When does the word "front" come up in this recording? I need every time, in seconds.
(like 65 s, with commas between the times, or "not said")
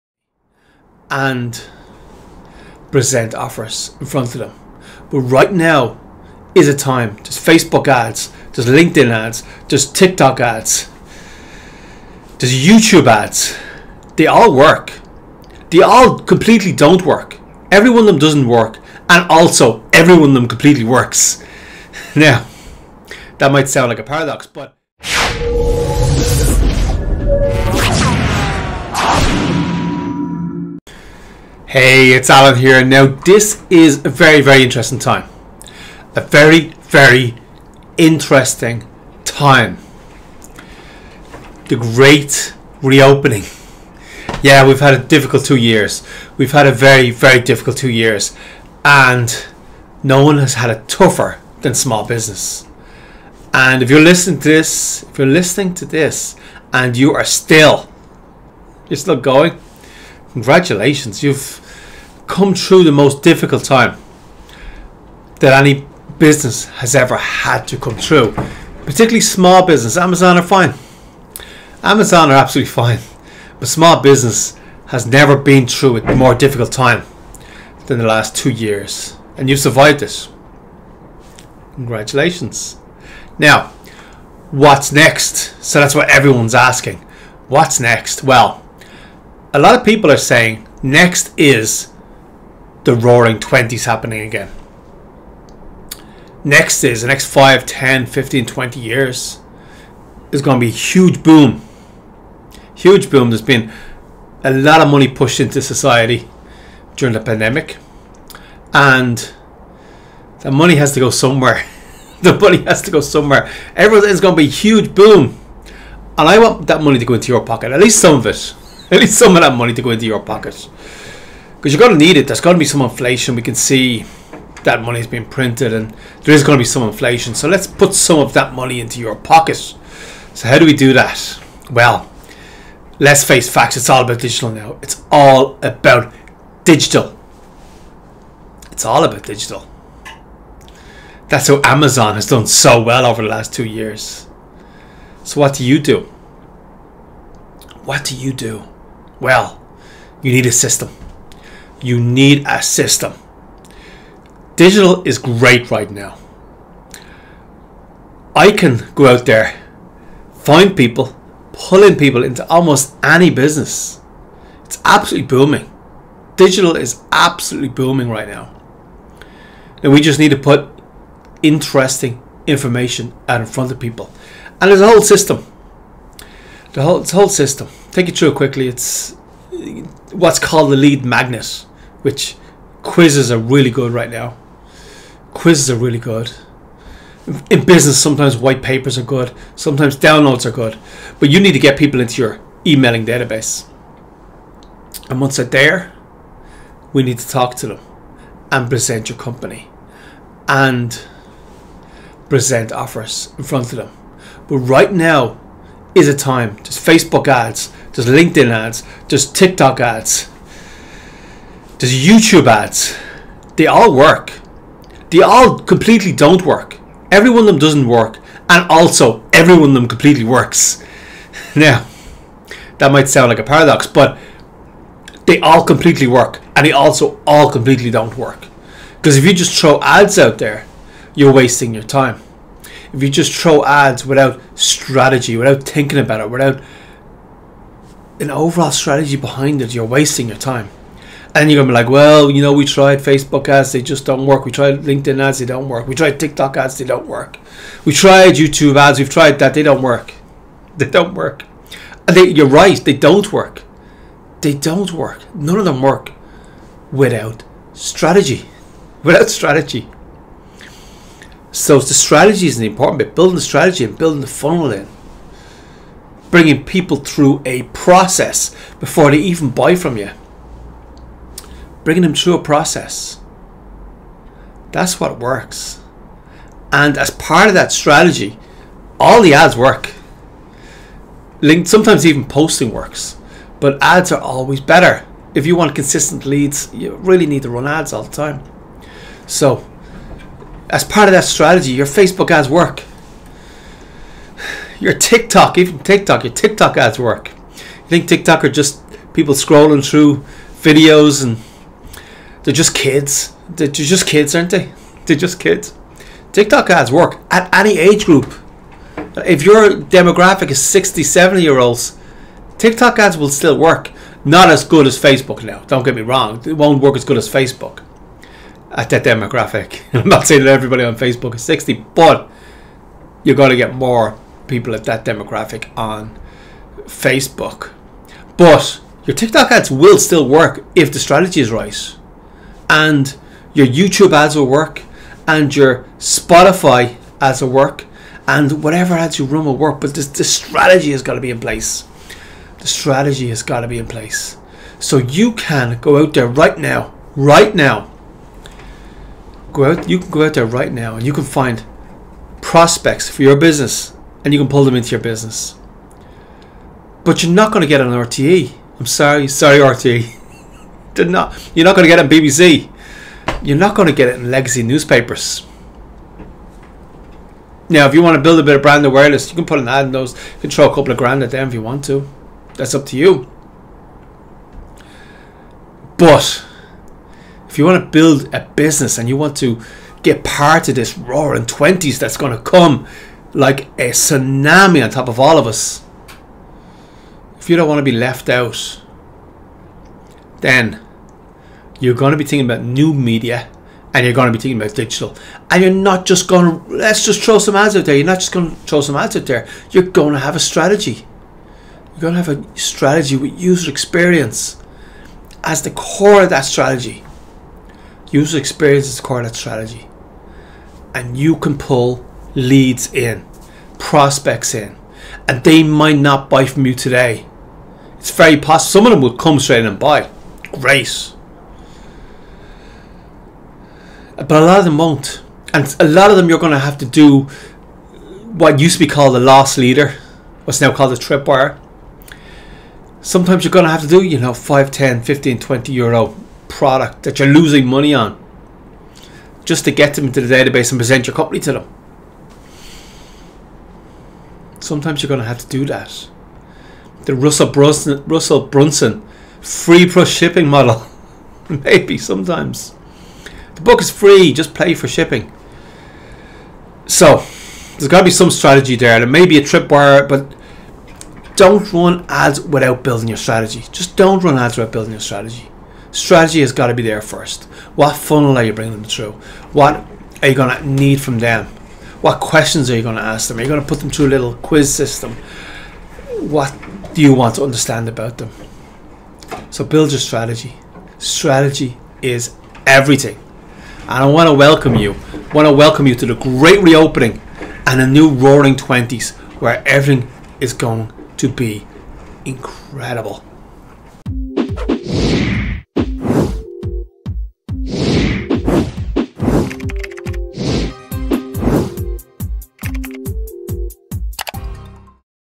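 4 s, 173 s, 203 s.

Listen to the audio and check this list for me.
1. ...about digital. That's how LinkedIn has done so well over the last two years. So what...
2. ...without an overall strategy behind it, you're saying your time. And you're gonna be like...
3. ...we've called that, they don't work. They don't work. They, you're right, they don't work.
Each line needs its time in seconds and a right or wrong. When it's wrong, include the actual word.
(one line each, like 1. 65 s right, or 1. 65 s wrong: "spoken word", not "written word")
1. 139 s wrong: "Amazon", not "LinkedIn"
2. 236 s wrong: "wasting", not "saying"
3. 248 s wrong: "tried", not "called".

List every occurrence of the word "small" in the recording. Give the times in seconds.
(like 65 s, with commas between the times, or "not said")
51 s, 69 s, 73 s.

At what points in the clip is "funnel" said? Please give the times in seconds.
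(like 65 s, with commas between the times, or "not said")
264 s, 467 s.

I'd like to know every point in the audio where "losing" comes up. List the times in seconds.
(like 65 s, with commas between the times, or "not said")
437 s.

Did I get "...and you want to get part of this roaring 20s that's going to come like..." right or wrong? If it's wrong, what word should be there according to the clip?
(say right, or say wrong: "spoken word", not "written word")
right.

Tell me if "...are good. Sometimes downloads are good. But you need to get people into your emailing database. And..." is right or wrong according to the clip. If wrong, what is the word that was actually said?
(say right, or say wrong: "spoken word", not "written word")
right.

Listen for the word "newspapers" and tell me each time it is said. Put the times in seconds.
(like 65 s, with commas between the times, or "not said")
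364 s.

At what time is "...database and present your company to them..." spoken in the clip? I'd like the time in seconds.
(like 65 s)
440 s.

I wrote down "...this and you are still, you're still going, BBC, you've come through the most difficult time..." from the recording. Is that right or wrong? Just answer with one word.
wrong.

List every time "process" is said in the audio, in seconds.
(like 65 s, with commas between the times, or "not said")
267 s, 272 s.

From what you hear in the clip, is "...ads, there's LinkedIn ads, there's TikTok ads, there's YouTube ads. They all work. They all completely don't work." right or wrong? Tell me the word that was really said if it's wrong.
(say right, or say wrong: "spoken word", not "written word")
right.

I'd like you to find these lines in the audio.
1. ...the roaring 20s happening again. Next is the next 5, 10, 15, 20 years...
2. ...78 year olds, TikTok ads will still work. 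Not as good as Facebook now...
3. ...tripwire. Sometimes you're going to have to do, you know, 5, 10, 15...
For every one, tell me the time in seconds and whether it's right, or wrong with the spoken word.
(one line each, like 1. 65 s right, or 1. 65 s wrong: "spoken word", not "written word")
1. 92 s right
2. 311 s wrong: "70", not "78"
3. 430 s right.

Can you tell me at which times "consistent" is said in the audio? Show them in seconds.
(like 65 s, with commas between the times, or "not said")
285 s.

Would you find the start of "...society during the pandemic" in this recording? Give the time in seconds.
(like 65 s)
105 s.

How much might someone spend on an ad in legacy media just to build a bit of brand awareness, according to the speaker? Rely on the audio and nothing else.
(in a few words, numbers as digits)
A couple of grand.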